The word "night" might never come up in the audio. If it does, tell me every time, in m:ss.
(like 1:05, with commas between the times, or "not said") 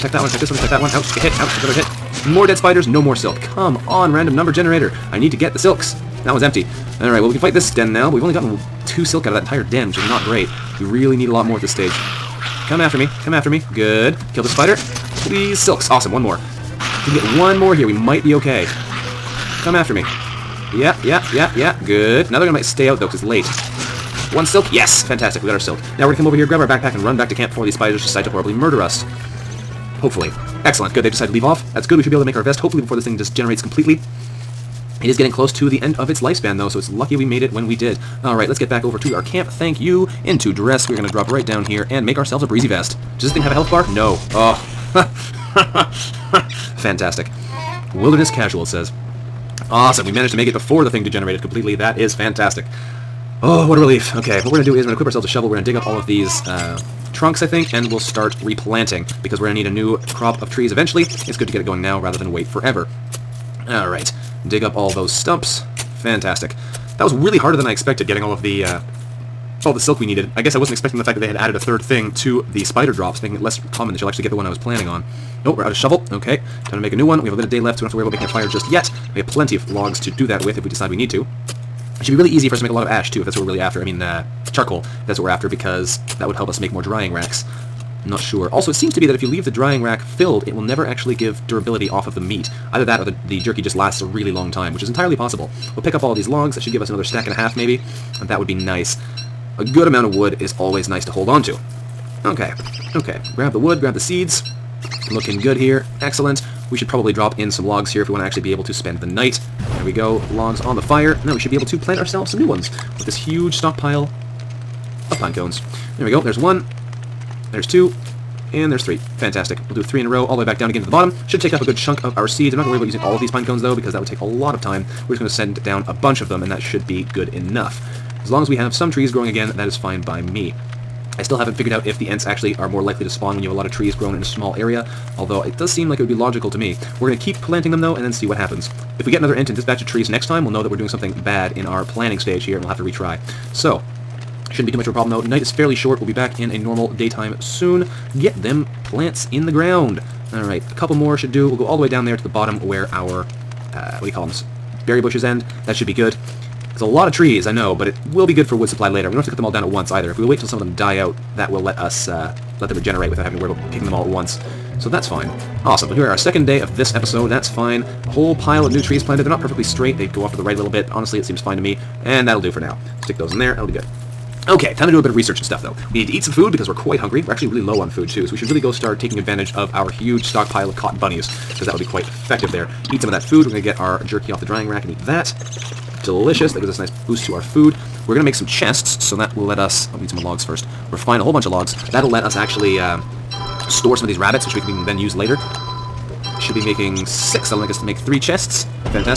1:49, 2:25.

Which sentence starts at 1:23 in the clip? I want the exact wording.
I mean, uh, charcoal, if that's what we're after, because that would help us make more drying racks.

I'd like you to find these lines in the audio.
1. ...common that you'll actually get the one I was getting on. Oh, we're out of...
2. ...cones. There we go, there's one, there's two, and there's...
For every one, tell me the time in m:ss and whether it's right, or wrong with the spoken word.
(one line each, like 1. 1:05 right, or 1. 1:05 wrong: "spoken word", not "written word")
1. 1:13 wrong: "planning", not "getting"
2. 1:55 right.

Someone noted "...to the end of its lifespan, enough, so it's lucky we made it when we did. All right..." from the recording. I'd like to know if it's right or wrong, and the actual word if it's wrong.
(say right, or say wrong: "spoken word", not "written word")
wrong: "though", not "enough".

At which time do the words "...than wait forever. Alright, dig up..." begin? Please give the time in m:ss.
1:02.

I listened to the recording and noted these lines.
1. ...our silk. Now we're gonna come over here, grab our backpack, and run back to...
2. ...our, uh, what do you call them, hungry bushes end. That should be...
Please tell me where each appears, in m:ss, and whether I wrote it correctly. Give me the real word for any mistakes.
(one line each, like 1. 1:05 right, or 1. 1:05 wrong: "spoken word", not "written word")
1. 0:25 right
2. 2:32 wrong: "berry", not "hungry".